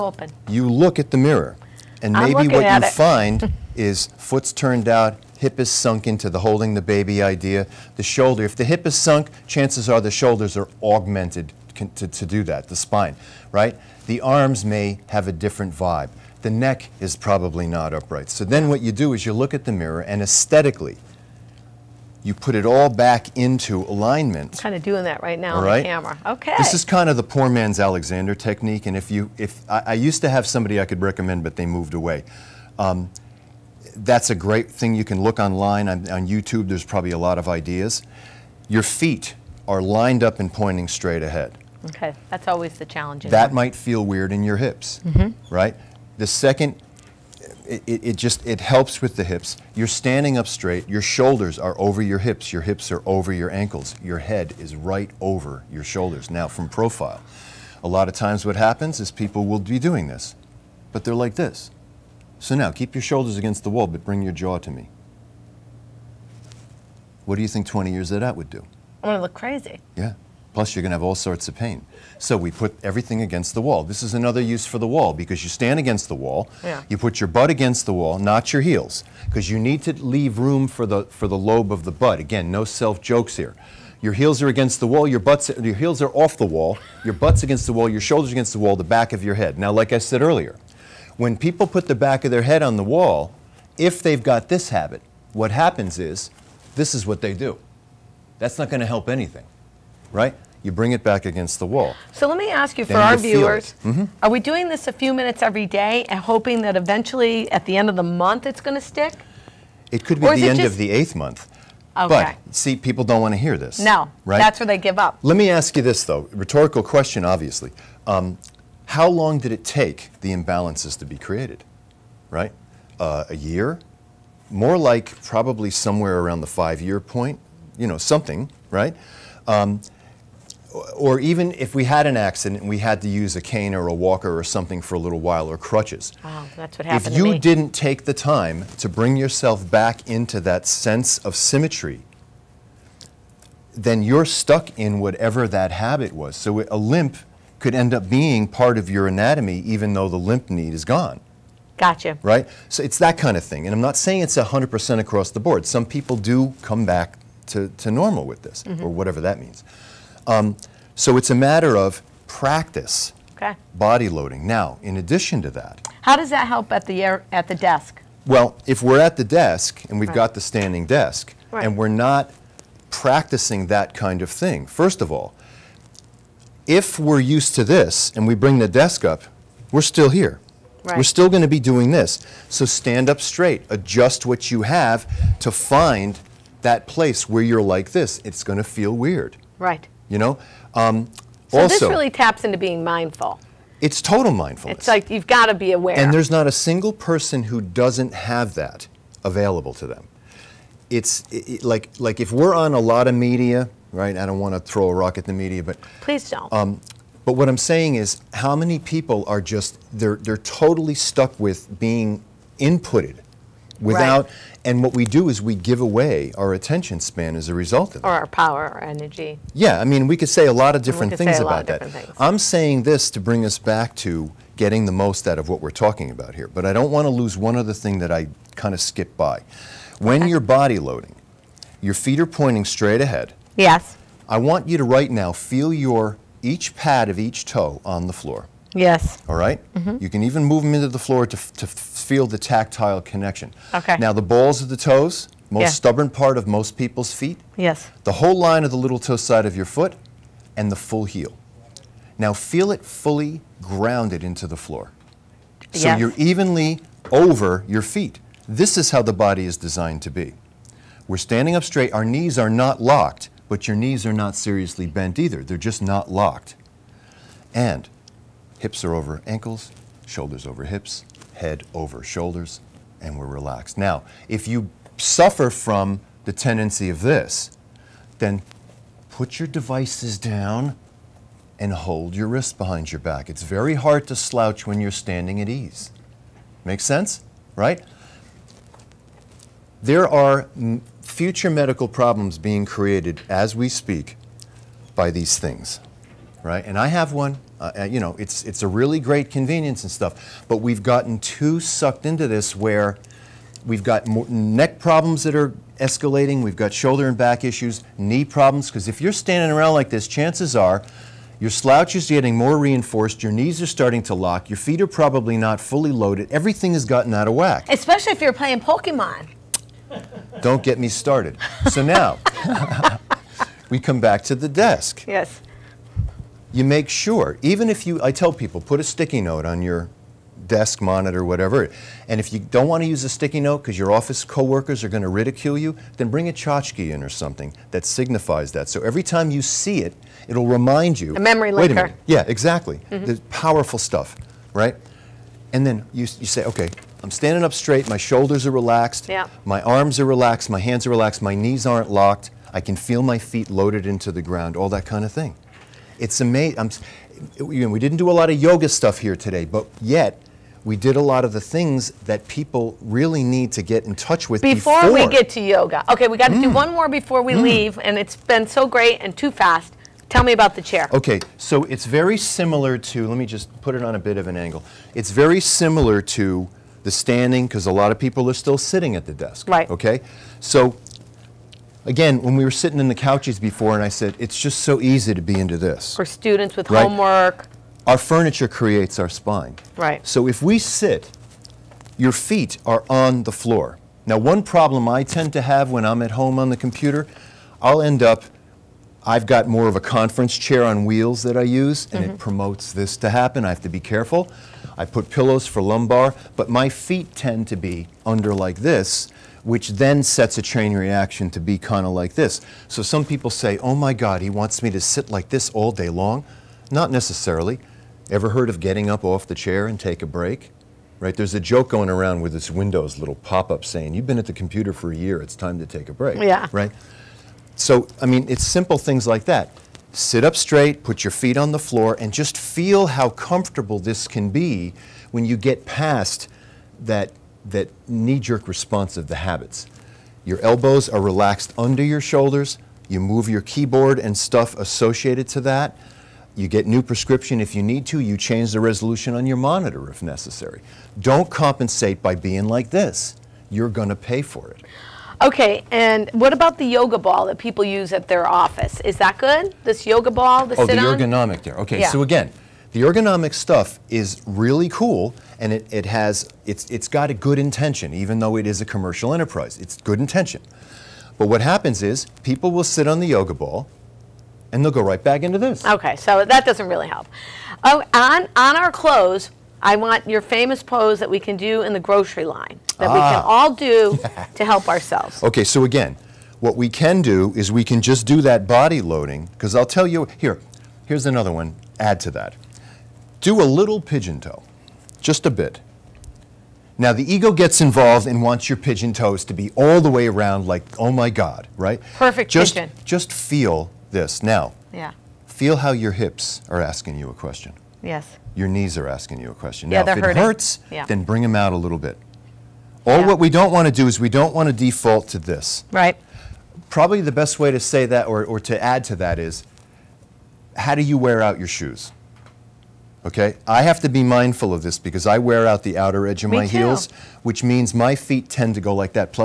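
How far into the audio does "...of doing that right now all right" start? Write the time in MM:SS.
00:24.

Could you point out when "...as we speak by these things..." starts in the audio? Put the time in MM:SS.
04:53.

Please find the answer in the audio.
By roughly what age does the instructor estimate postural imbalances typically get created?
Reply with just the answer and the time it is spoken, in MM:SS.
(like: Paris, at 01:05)
5 years, at 02:06.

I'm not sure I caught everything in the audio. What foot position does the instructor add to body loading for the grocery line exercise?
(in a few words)
pigeon toe.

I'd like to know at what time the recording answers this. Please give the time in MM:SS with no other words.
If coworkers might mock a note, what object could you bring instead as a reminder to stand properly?
05:36.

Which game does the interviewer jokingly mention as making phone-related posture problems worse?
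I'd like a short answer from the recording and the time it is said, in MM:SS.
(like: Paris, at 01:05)
Pokemon, at 05:18.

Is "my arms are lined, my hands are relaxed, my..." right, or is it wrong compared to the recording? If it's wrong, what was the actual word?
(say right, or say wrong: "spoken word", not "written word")
wrong: "relaxed", not "lined".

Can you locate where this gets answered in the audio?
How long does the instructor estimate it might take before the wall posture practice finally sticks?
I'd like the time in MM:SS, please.
01:50.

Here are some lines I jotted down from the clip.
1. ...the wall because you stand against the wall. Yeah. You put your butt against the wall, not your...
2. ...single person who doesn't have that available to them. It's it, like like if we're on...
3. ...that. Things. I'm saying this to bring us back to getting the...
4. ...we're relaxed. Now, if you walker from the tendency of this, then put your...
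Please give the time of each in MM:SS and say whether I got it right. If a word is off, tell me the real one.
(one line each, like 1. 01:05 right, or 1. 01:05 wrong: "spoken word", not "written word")
1. 01:14 right
2. 03:16 right
3. 03:41 right
4. 04:33 wrong: "suffer", not "walker".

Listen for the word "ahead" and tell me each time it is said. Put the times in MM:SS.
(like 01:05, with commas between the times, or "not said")
00:41, 03:53.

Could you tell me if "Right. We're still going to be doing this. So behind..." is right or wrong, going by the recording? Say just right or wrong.
wrong.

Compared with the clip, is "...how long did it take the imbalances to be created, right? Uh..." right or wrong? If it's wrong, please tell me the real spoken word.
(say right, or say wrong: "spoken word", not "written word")
right.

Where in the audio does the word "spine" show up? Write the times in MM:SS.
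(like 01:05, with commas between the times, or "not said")
00:12, 06:29.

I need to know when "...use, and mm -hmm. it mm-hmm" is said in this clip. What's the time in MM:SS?
06:41.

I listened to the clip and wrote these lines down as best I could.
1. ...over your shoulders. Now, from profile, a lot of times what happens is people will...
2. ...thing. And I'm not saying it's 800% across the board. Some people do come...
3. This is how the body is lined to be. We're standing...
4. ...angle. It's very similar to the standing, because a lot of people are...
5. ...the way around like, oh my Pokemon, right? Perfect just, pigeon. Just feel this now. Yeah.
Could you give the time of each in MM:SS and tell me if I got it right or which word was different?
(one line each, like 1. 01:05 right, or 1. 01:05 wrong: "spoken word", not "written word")
1. 00:55 right
2. 02:33 wrong: "100", not "800"
3. 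04:18 wrong: "designed", not "lined"
4. 06:14 right
5. 08:19 wrong: "God", not "Pokemon".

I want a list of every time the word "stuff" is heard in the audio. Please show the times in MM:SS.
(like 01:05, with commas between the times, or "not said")
04:59, 05:43, 05:58, 07:24, 07:43.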